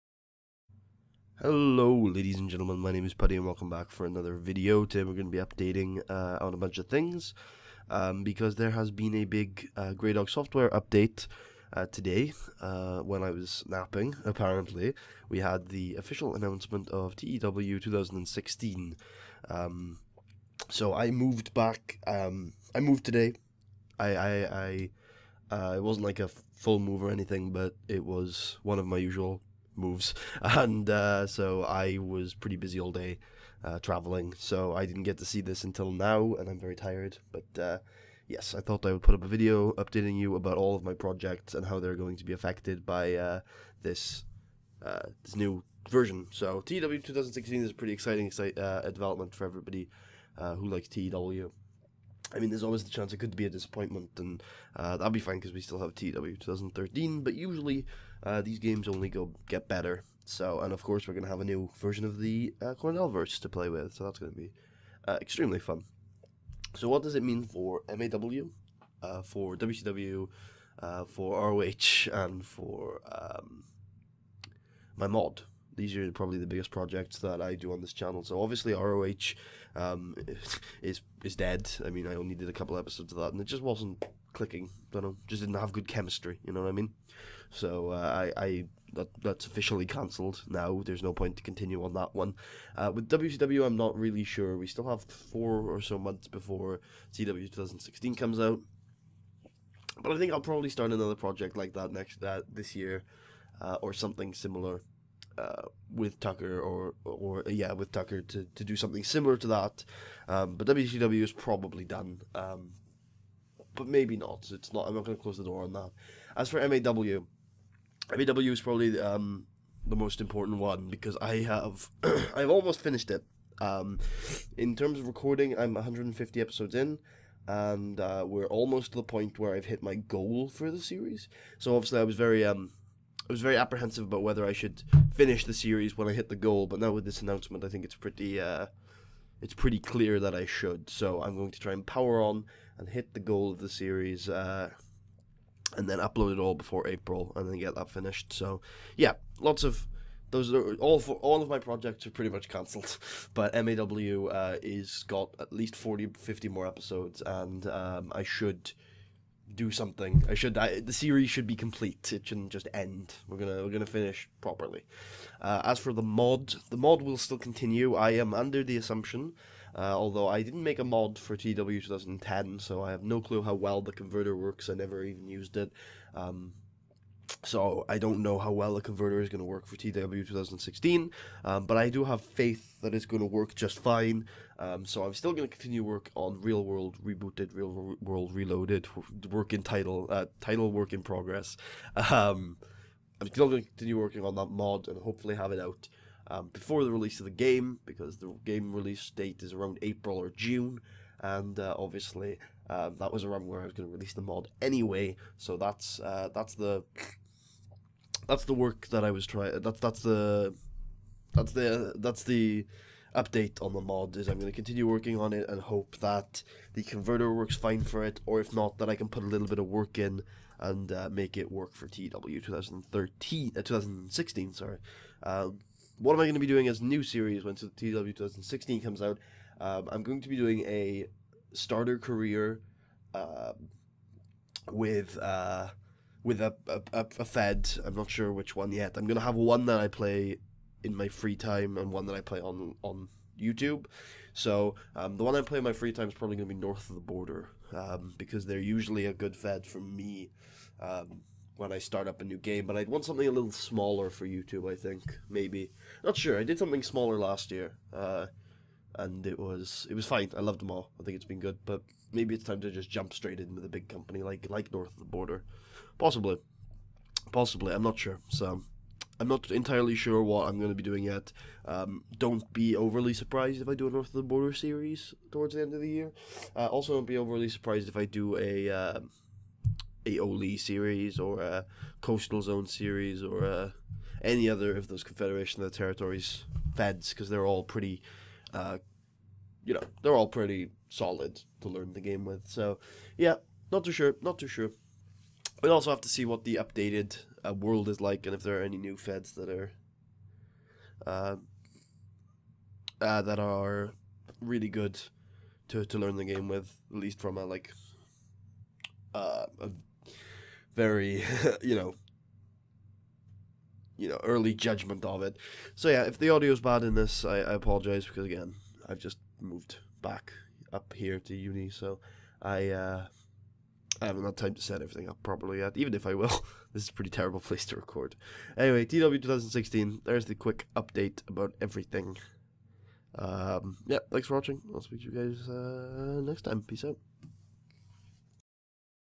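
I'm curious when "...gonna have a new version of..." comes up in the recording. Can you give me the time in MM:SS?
01:01.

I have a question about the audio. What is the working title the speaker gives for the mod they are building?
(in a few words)
Real World Reloaded.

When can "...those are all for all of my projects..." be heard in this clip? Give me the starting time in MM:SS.
02:30.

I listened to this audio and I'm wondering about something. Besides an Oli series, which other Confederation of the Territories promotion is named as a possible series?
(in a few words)
Coastal Zone.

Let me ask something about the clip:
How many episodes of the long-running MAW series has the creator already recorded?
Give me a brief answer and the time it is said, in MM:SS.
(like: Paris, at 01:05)
150, at 02:05.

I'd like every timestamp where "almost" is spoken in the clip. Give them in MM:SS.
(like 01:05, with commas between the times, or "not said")
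02:02, 02:08.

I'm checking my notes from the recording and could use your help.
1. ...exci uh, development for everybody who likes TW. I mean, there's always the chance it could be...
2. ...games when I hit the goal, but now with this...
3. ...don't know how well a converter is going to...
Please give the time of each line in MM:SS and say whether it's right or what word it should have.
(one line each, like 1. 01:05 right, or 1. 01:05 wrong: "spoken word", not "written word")
1. 00:48 right
2. 02:15 wrong: "series", not "games"
3. 02:57 right.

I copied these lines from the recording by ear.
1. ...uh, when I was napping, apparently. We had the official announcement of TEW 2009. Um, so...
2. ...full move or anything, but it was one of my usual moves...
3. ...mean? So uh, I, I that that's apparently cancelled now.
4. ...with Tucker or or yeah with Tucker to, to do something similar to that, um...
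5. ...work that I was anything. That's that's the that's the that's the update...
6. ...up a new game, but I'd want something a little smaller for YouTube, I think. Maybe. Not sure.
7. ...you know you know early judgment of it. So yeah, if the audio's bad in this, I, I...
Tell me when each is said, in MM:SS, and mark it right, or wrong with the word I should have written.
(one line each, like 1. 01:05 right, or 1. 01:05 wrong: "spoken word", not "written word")
1. 00:12 wrong: "2016", not "2009"
2. 00:26 right
3. 01:26 wrong: "officially", not "apparently"
4. 01:45 right
5. 03:28 wrong: "trying", not "anything"
6. 04:12 right
7. 05:11 right.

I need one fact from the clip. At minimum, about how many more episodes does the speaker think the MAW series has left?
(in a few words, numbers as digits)
40 50.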